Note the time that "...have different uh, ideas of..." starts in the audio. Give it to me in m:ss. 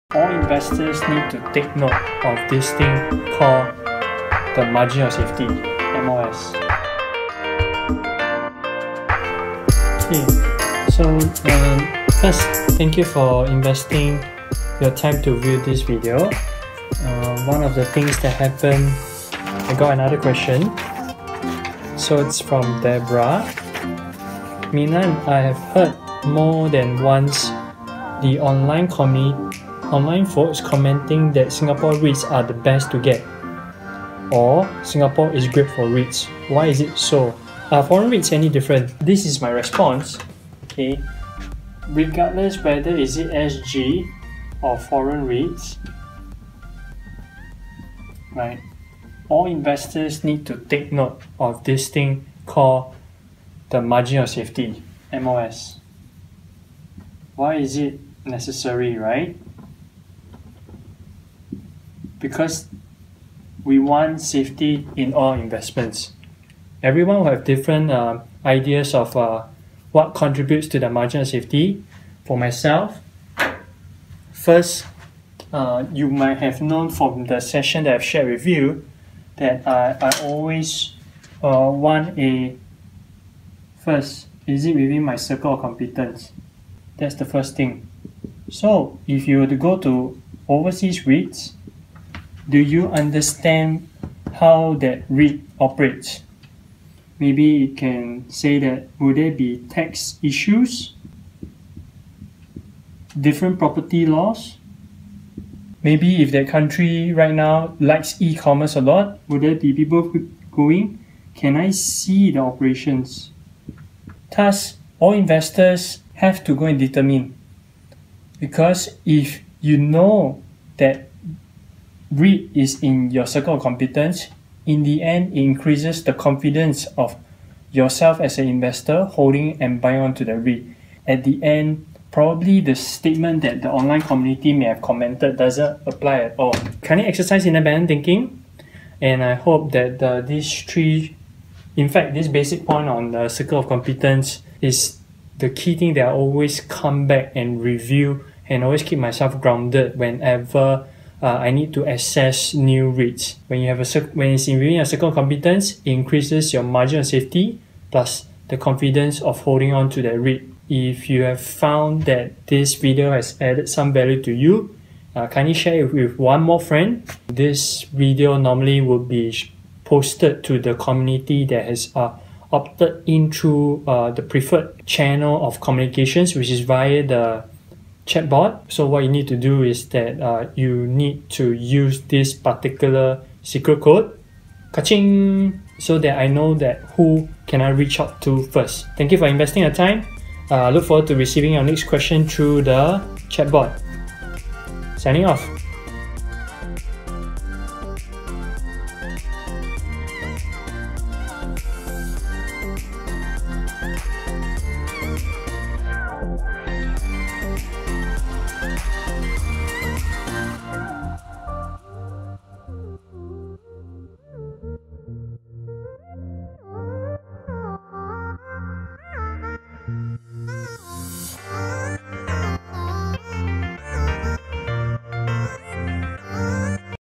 1:07.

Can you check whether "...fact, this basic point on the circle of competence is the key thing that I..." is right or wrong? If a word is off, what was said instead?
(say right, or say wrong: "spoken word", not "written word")
right.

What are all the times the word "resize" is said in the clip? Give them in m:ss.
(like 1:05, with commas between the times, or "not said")
not said.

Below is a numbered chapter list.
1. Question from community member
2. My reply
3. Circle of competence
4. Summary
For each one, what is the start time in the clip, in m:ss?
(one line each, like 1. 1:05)
1. 0:19
2. 0:39
3. 1:28
4. 2:17.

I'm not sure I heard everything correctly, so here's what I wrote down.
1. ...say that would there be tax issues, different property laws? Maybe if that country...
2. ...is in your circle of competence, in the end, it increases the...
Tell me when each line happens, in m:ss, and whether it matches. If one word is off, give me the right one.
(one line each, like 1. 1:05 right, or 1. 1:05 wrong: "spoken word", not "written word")
1. 1:38 right
2. 2:02 right.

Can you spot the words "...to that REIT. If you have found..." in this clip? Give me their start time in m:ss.
2:39.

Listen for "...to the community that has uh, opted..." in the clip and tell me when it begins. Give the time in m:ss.
2:50.